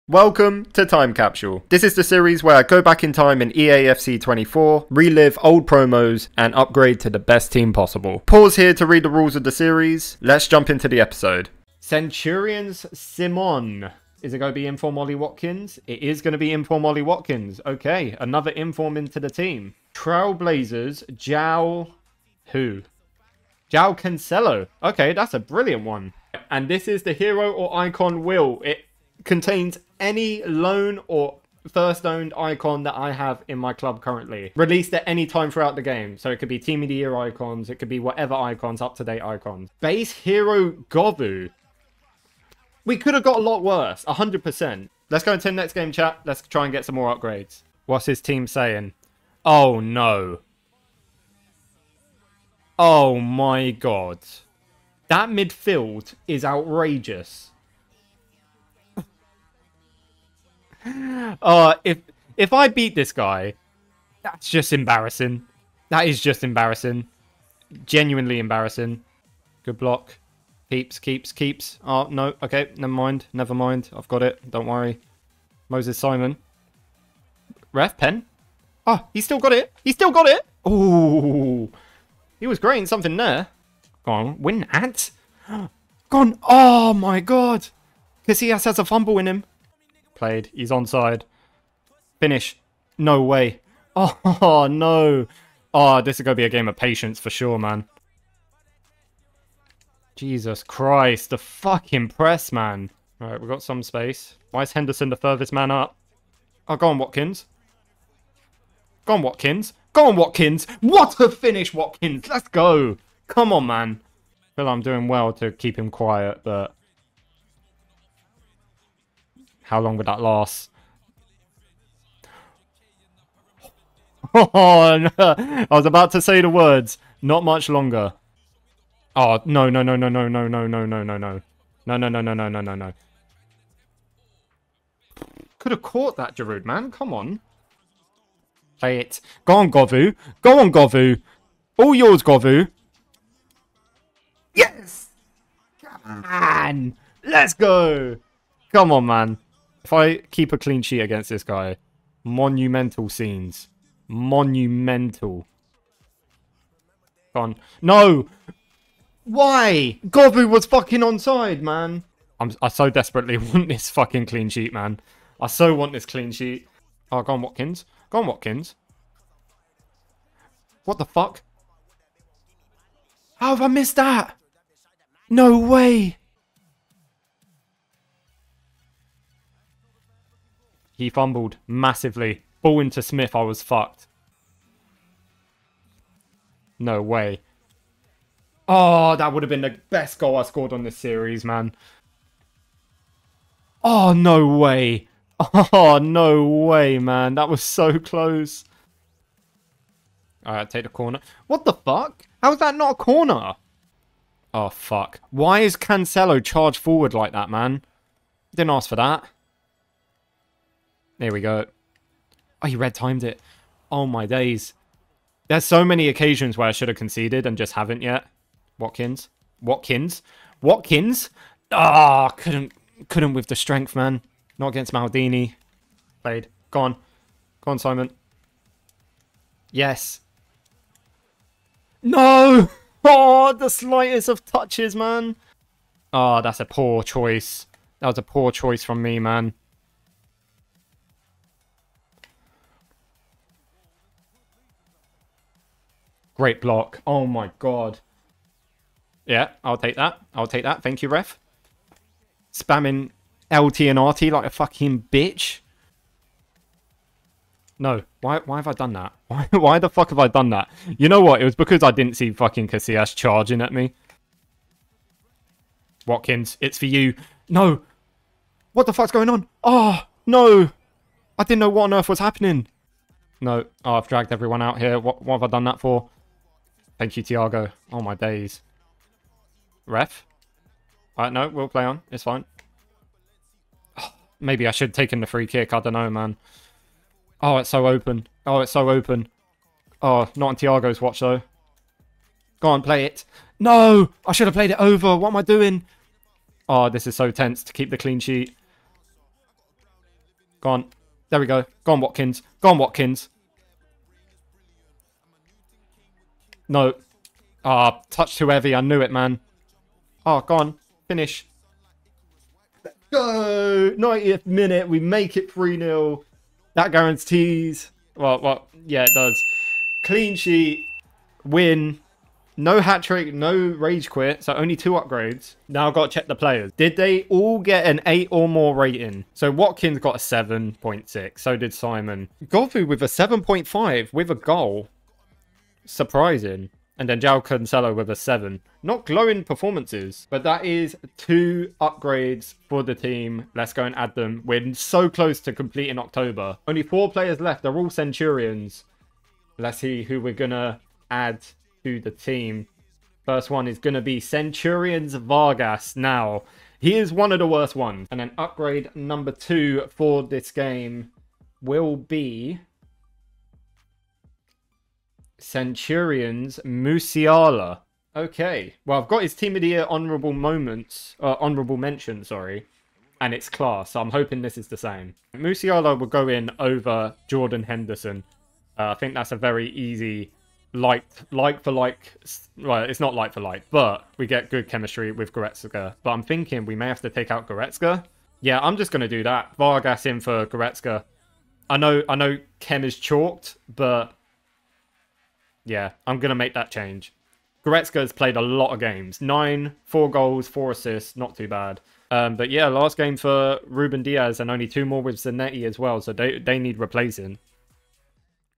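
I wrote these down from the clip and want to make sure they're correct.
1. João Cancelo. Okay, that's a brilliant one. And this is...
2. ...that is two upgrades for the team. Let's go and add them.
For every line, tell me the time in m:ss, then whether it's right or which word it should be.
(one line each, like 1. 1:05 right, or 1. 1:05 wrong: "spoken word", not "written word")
1. 0:23 right
2. 5:40 right.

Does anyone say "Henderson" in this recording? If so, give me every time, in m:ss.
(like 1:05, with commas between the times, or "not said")
1:44, 6:17.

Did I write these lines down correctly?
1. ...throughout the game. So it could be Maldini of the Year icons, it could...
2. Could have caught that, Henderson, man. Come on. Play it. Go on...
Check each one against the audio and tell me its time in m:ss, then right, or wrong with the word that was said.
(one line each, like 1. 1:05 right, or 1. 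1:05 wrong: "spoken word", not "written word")
1. 0:35 wrong: "Team", not "Maldini"
2. 2:15 wrong: "Giroud", not "Henderson".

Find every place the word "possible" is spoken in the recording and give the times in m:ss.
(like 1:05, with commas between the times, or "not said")
0:07.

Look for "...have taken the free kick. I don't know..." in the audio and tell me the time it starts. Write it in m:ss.
4:44.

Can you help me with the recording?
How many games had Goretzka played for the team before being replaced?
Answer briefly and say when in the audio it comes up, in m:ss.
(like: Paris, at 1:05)
9, at 6:39.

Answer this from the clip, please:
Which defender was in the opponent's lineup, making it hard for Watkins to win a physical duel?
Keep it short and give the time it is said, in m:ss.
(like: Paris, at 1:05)
Maldini, at 3:44.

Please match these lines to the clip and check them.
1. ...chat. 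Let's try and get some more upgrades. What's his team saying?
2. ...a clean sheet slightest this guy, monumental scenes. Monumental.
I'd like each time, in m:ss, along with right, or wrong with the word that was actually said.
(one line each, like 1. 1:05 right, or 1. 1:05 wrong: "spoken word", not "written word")
1. 0:45 right
2. 2:30 wrong: "against", not "slightest".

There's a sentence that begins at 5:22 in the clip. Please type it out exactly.
No hat trick, no rage quit, so only two upgrades.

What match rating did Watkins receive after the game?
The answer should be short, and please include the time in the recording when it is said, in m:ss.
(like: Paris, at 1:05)
7.6, at 5:30.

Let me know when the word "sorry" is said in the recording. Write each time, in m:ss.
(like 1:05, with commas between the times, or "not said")
6:12.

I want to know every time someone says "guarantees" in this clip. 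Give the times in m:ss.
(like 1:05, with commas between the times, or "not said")
5:16.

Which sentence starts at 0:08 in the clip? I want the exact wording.
Pause here to read the rules of the series.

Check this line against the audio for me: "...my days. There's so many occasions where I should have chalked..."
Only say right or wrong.
wrong.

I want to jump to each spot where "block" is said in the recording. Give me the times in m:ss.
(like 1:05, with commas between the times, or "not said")
1:09, 4:06.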